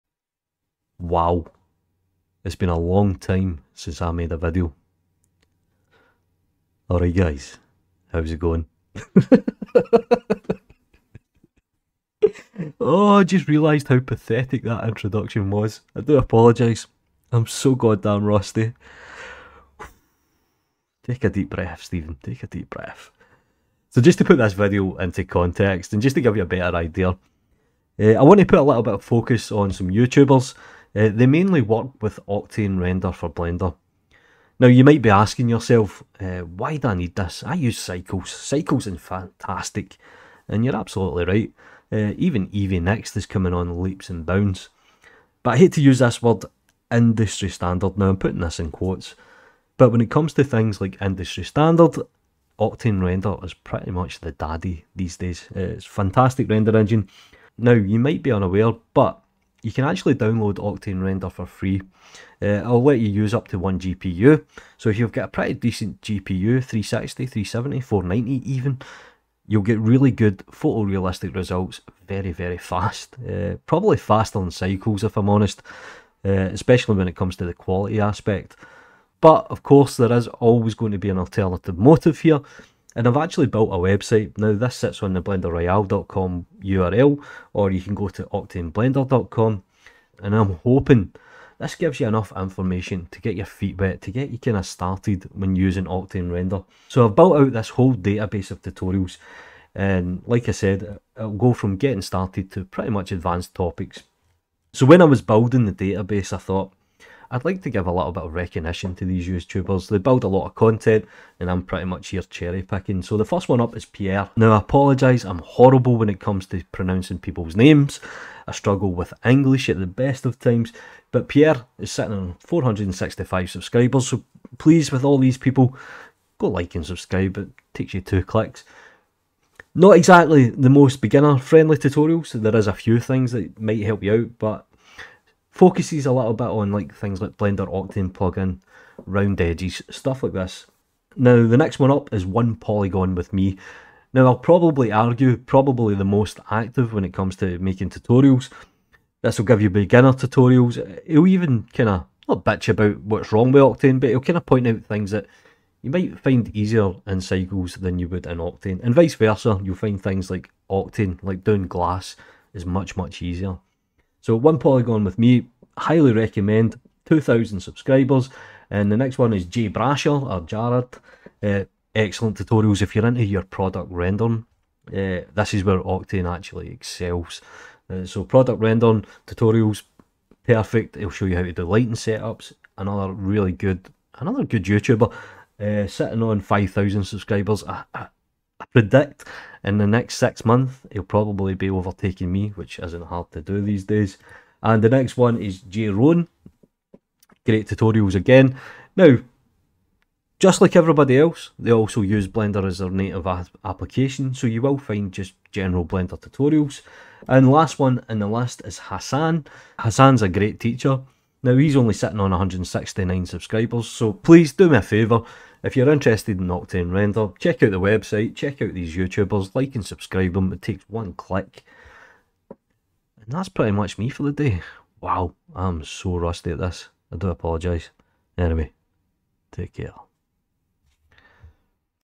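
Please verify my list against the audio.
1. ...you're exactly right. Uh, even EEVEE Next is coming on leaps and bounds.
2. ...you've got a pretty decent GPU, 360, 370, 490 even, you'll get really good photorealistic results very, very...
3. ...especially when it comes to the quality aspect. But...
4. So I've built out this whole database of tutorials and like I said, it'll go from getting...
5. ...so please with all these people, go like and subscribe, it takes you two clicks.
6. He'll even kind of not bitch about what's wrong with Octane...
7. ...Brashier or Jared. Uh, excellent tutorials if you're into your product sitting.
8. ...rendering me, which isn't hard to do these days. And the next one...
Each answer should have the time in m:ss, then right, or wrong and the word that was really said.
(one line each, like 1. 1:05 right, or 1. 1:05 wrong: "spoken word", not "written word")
1. 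0:40 wrong: "absolutely", not "exactly"
2. 1:04 right
3. 1:16 right
4. 1:36 right
5. 2:04 right
6. 2:31 right
7. 2:49 wrong: "rendering", not "sitting"
8. 3:11 wrong: "overtaking", not "rendering".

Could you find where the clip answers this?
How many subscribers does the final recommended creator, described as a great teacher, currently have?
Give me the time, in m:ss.
3:32.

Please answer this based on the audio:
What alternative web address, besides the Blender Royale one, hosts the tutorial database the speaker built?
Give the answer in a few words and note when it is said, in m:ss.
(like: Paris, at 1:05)
octaneblender.com, at 1:28.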